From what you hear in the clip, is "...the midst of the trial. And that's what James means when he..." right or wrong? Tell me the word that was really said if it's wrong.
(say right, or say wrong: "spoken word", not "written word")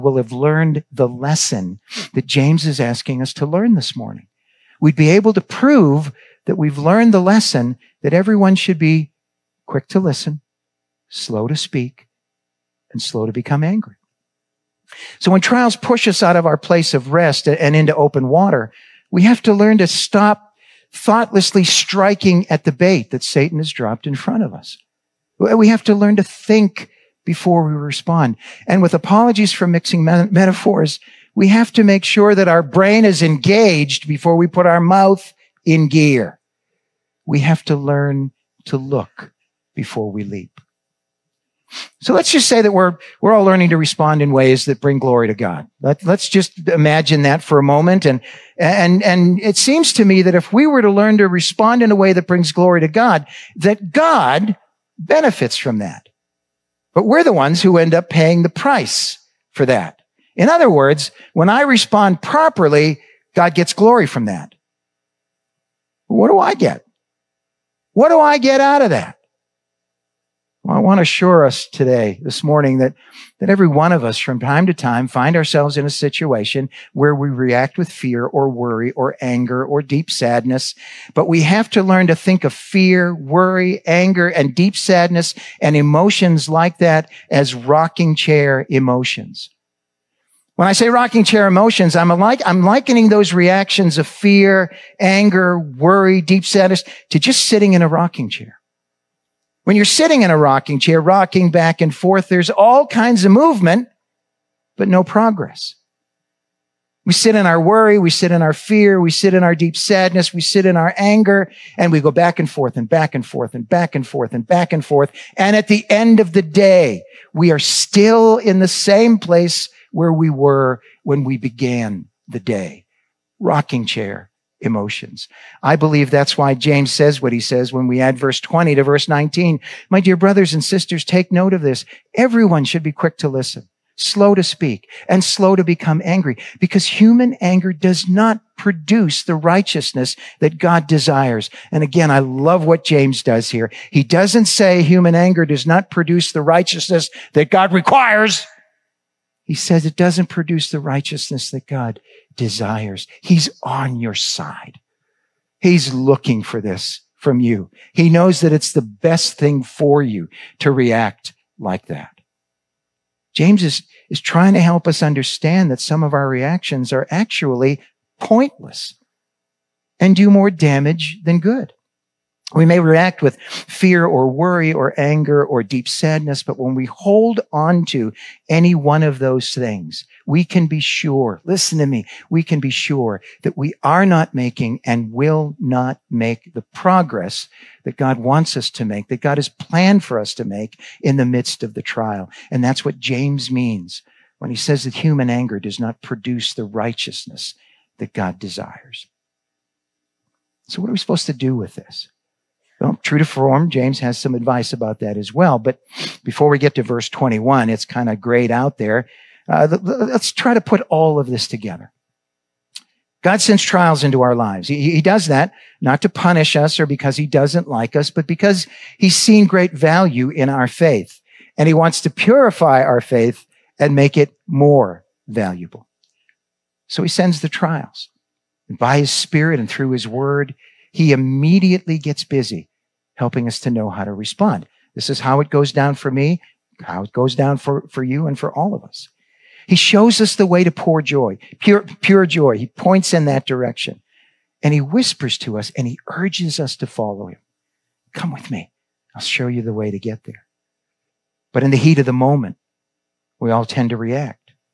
right.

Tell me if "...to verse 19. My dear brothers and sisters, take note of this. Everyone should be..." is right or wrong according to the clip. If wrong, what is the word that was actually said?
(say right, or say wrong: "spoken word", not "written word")
right.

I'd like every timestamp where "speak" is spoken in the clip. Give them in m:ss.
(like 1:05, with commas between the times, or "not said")
0:11, 2:14.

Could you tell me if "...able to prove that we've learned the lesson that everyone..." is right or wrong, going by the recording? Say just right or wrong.
right.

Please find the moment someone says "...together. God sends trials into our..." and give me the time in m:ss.
3:31.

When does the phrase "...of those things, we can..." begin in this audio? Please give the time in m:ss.
2:59.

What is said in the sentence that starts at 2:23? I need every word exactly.
He doesn't say human anger does not produce the righteousness that God requires.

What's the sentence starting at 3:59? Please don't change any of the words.
He shows us the way to pure joy, pure, pure joy.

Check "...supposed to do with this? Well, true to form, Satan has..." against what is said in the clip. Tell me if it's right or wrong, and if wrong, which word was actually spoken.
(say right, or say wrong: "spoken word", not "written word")
wrong: "James", not "Satan".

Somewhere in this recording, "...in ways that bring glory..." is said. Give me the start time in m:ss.
0:44.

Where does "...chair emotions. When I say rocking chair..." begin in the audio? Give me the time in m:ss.
1:28.